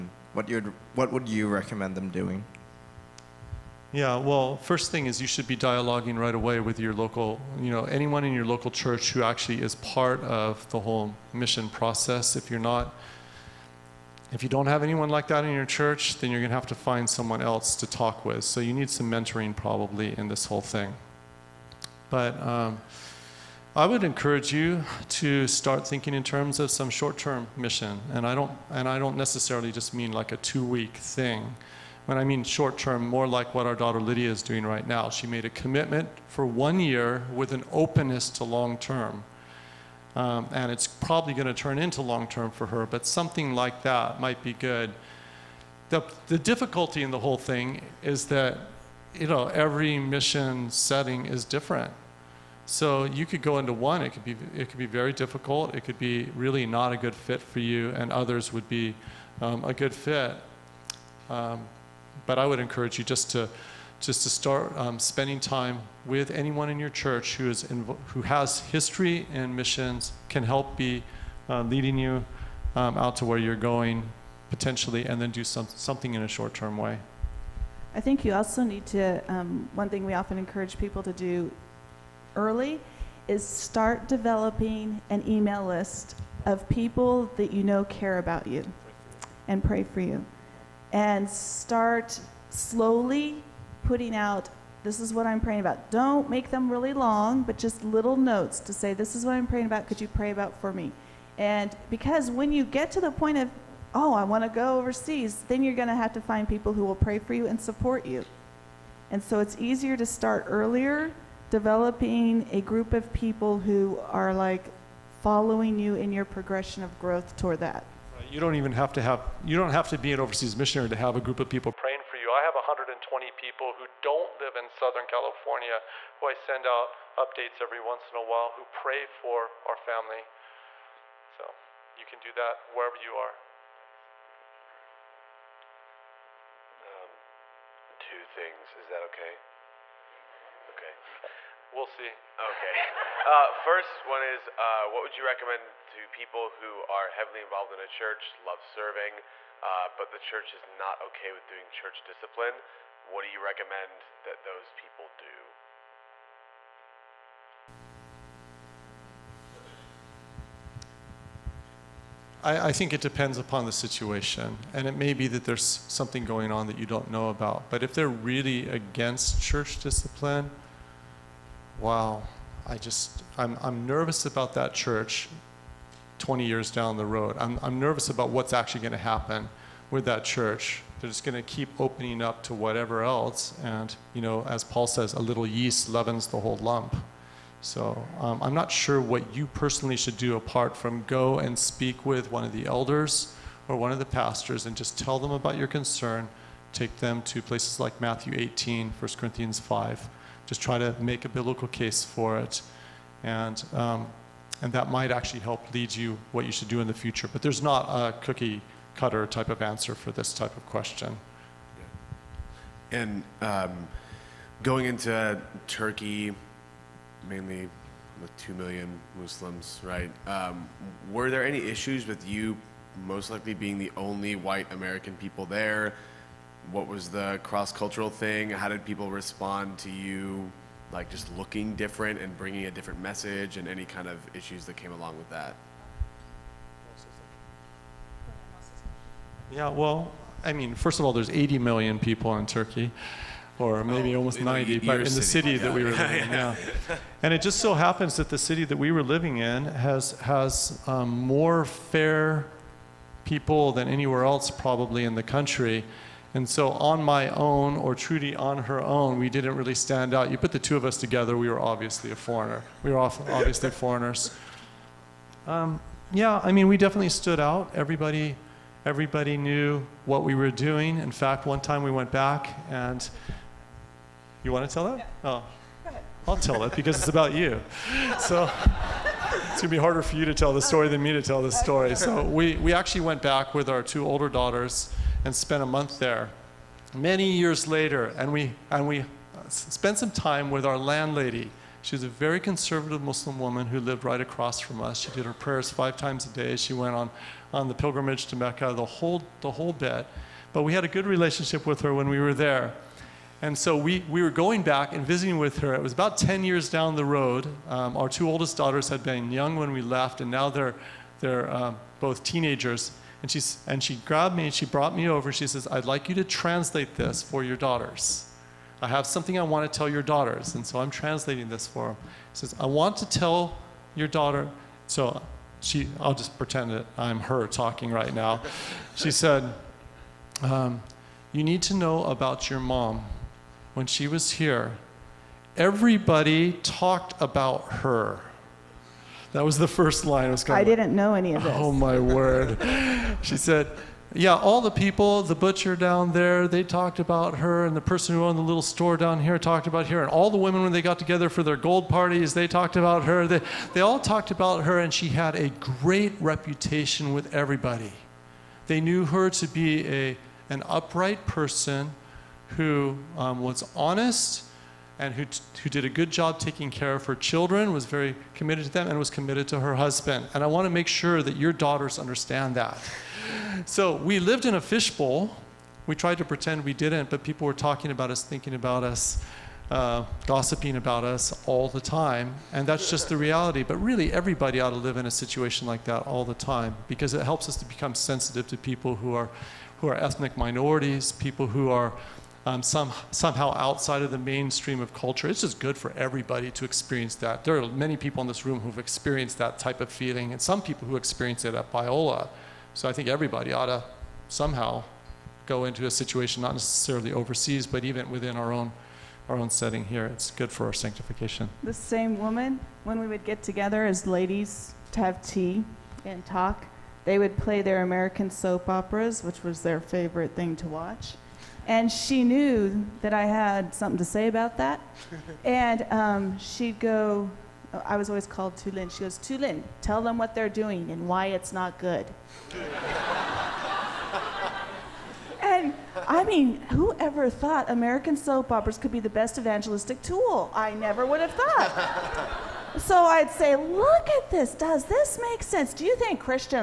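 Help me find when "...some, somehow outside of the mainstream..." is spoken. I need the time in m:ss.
6:32.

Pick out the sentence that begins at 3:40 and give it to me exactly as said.
Um, were there any issues with you most likely being the only white American people there?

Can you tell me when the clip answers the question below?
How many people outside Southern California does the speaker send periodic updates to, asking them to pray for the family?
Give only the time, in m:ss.
2:02.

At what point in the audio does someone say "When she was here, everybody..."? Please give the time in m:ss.
5:33.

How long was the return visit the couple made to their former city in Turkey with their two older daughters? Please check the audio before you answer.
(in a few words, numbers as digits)
A month.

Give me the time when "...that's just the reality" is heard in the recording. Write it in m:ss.
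6:22.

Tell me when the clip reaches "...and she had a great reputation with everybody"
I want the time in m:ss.
5:54.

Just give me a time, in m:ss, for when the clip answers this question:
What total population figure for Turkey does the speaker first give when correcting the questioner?
4:01.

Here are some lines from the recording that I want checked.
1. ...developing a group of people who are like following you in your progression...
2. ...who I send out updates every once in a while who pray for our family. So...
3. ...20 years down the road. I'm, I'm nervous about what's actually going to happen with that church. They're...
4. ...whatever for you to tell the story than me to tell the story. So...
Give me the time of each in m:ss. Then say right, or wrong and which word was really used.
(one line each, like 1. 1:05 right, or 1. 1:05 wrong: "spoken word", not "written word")
1. 1:51 right
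2. 2:06 right
3. 2:56 right
4. 4:39 wrong: "harder", not "whatever".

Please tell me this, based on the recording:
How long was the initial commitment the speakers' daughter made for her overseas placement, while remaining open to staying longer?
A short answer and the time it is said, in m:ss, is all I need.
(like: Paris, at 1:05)
1 year, at 0:36.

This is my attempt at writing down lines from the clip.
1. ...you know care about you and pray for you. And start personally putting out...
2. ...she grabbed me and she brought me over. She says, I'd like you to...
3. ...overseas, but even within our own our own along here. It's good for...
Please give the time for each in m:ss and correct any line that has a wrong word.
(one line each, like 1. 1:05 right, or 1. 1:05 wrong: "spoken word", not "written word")
1. 1:27 wrong: "slowly", not "personally"
2. 5:13 right
3. 6:47 wrong: "setting", not "along".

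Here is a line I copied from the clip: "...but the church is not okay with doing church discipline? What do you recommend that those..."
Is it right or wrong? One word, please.
right.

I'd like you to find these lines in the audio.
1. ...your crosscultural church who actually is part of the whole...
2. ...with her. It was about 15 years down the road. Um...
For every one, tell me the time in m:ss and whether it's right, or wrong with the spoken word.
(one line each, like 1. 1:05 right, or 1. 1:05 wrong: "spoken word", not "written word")
1. 0:08 wrong: "local", not "crosscultural"
2. 5:05 wrong: "10", not "15".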